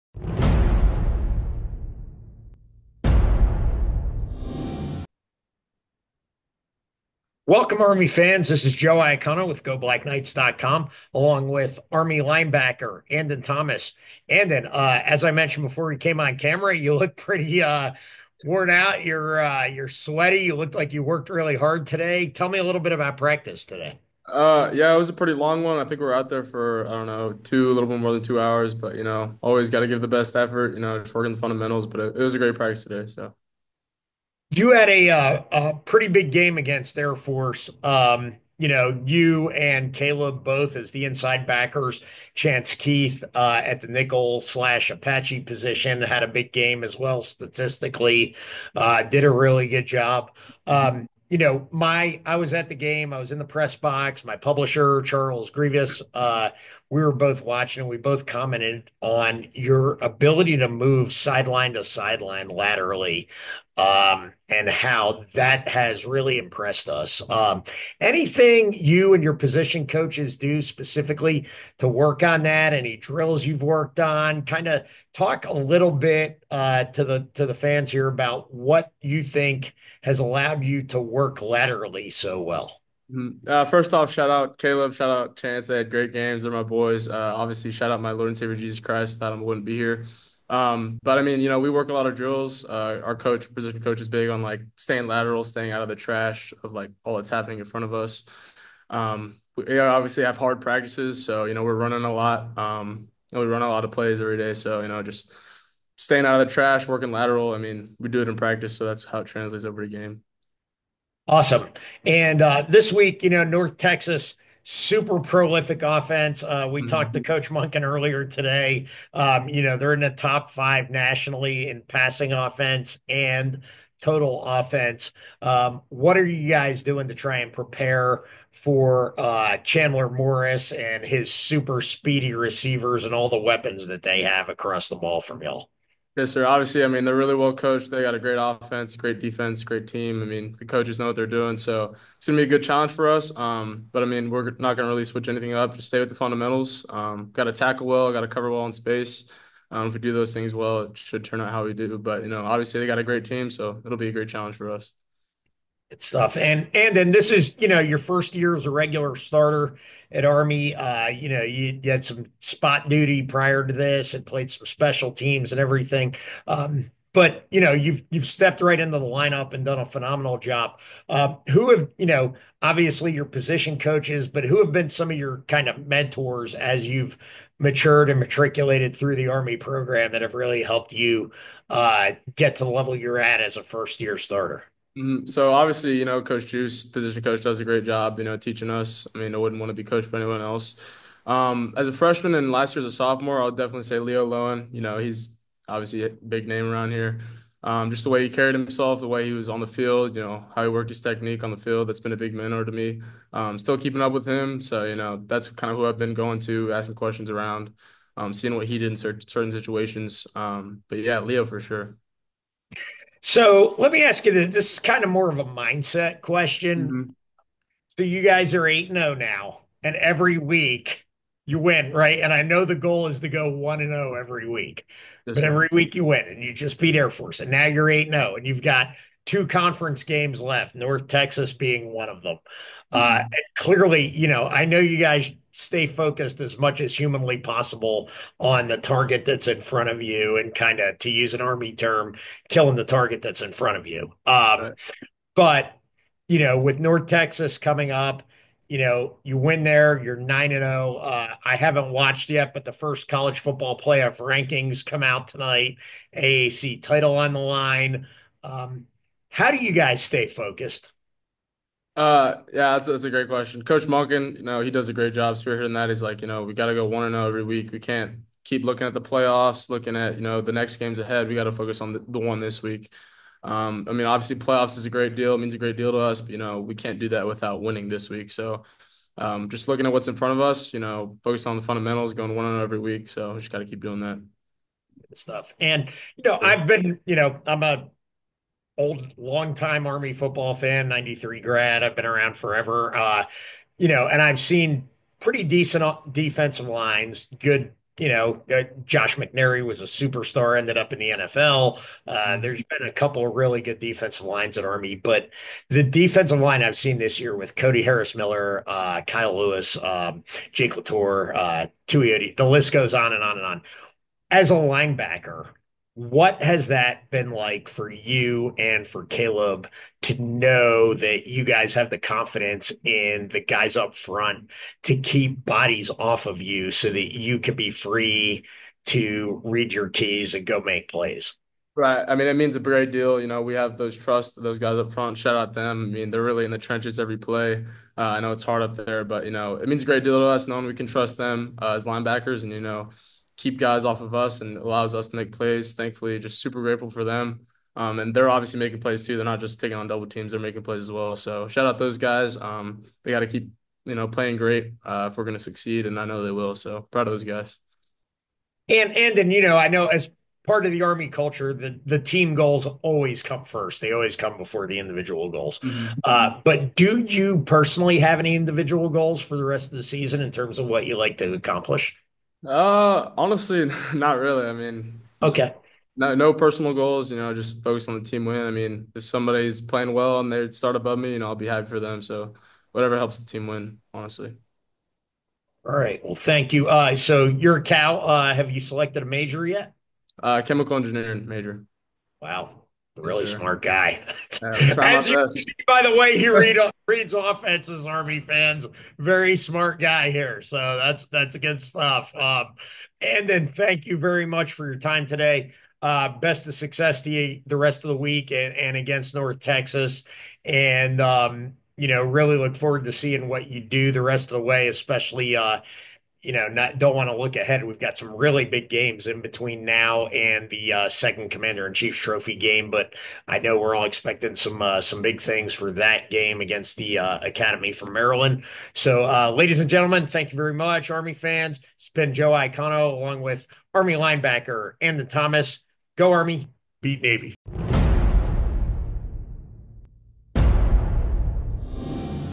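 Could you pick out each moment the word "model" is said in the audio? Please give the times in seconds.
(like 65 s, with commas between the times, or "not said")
not said.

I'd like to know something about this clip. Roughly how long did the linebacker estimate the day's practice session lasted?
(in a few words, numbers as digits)
a little more than 2 hours.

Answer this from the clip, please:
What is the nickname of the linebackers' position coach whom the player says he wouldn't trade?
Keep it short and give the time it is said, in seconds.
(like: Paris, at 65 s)
Coach Juice, at 186 s.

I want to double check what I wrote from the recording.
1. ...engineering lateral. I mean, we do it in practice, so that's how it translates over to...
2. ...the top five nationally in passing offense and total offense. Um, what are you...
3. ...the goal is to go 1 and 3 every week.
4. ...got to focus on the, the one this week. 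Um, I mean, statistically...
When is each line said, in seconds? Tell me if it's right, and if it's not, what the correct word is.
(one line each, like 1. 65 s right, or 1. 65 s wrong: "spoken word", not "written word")
1. 106 s wrong: "working", not "engineering"
2. 120 s right
3. 222 s wrong: "0", not "3"
4. 271 s wrong: "obviously", not "statistically".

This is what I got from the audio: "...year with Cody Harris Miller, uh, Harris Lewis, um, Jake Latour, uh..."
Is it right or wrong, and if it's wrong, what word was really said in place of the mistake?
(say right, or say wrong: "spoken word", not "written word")
wrong: "Kyle", not "Harris".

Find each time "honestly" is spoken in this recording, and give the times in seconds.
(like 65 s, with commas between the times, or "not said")
373 s, 383 s.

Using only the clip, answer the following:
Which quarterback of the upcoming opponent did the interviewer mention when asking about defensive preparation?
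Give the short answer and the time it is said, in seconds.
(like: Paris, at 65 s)
Chandler Morris, at 129 s.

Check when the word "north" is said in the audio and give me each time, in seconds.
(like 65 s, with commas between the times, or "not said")
113 s, 230 s, 246 s, 409 s.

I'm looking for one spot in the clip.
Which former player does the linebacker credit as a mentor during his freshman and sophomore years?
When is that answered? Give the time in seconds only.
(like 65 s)
193 s.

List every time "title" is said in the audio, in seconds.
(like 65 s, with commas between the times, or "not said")
256 s.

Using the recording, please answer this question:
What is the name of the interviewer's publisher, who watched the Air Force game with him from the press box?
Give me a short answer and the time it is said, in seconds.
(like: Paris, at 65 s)
Charles Grievous, at 55 s.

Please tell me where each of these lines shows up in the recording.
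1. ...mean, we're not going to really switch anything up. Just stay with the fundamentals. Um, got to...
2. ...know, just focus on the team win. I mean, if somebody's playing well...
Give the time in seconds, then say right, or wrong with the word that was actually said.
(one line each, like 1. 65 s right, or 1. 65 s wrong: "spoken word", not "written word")
1. 144 s right
2. 377 s right.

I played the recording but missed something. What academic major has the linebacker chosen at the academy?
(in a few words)
Chemical engineering.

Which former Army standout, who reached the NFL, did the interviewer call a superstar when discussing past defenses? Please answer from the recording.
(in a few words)
Josh McNary.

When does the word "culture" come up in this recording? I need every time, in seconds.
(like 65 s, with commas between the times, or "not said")
361 s.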